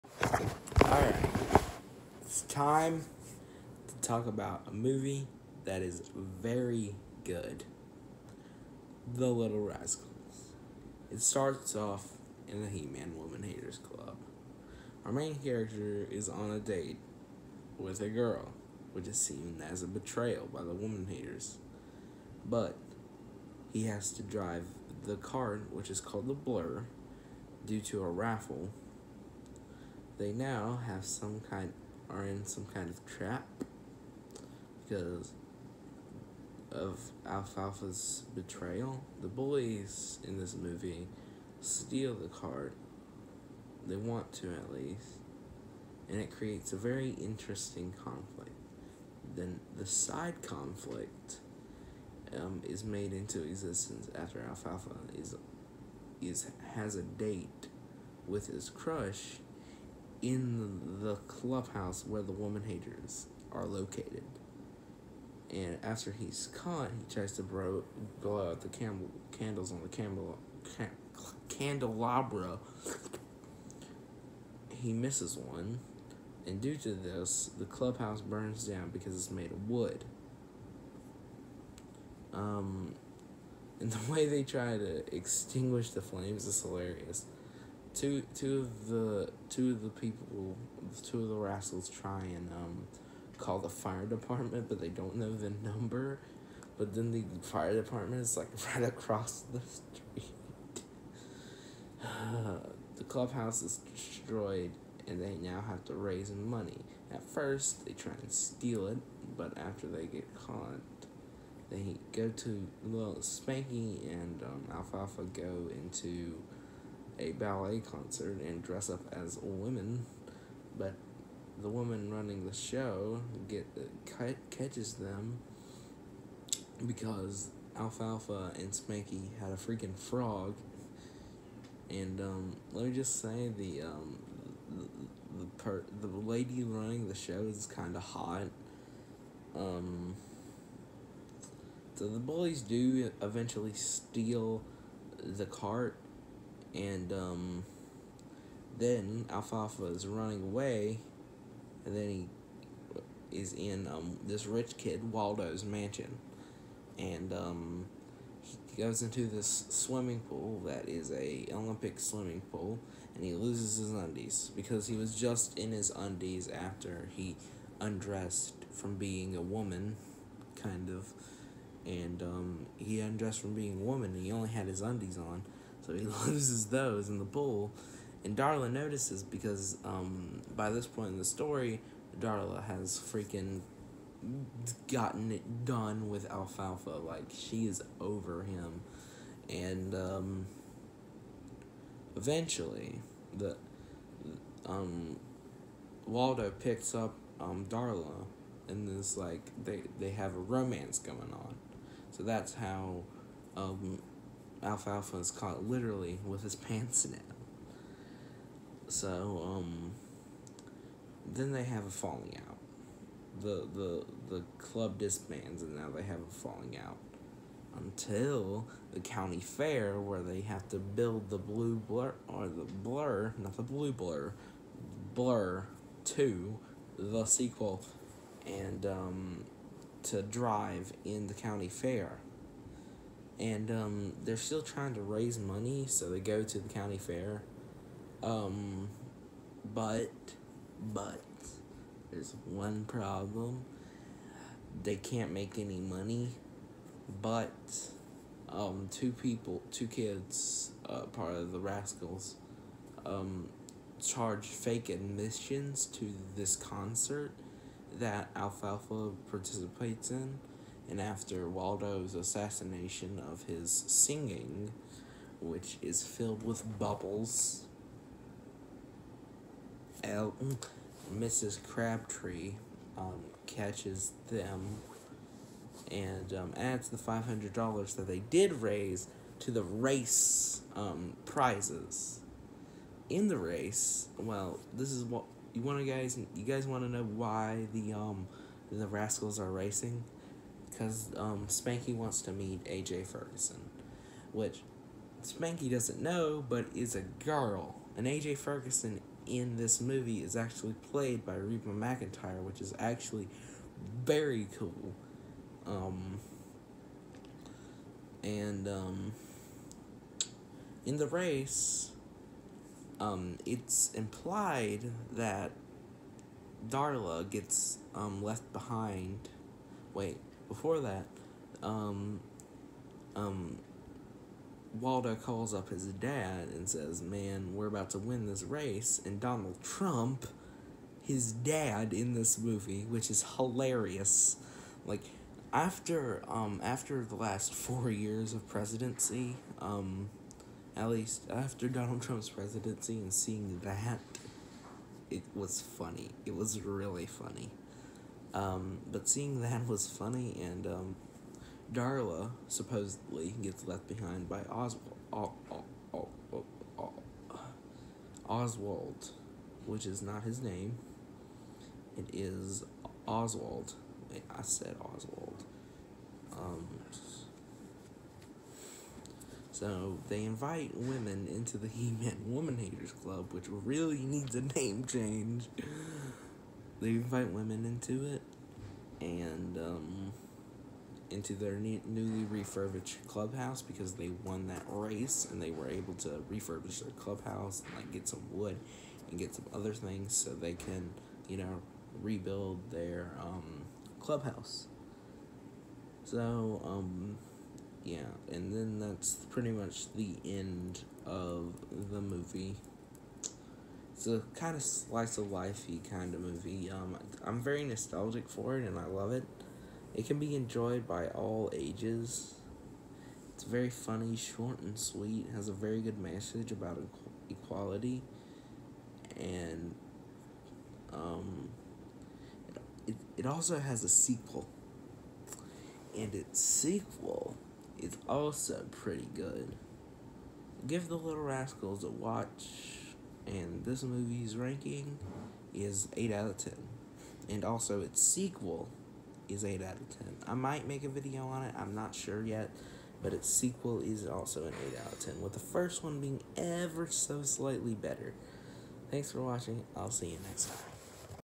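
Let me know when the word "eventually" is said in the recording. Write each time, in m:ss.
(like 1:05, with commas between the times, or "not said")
2:23, 3:12.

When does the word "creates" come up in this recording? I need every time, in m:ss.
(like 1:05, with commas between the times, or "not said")
0:46.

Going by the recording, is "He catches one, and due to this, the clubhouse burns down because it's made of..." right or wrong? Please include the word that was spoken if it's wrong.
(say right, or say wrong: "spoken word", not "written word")
wrong: "misses", not "catches".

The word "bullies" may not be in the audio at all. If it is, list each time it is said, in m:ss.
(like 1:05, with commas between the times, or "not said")
2:22.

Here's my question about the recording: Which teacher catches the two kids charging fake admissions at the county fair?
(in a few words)
Mrs. Crabtree.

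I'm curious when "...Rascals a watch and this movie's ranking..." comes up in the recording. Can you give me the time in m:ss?
7:11.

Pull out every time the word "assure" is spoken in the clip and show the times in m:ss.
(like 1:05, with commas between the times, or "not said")
not said.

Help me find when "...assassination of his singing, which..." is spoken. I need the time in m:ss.
4:22.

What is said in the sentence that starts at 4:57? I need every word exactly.
And AJ Ferguson in this movie is actually played by Reba McEntire, which is actually very cool.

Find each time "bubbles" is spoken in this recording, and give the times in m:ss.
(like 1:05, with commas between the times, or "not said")
4:26.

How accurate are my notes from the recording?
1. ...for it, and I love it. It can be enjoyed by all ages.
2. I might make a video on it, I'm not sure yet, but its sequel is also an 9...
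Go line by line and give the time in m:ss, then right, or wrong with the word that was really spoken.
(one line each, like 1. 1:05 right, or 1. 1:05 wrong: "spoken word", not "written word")
1. 6:48 right
2. 7:20 wrong: "8", not "9".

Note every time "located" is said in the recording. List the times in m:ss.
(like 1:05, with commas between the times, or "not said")
1:03.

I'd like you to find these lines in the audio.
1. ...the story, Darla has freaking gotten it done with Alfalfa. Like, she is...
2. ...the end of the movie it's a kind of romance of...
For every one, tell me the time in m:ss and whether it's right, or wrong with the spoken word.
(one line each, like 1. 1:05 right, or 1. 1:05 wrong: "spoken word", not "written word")
1. 3:01 right
2. 6:39 wrong: "slice", not "romance".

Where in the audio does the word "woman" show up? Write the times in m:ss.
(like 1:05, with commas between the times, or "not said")
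0:13, 0:20, 1:02, 2:01, 2:49, 2:53, 6:12.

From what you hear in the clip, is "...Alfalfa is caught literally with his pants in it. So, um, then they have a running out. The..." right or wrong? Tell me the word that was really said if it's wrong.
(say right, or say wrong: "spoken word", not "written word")
wrong: "falling", not "running".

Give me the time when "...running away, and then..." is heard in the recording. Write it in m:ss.
2:30.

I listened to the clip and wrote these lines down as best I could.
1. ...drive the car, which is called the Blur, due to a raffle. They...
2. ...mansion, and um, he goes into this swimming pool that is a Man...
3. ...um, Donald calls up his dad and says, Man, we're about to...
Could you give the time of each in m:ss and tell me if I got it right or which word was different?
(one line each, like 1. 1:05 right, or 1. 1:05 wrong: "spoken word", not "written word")
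1. 0:24 right
2. 2:35 wrong: "Olympic", not "Man"
3. 5:23 wrong: "Waldo", not "Donald".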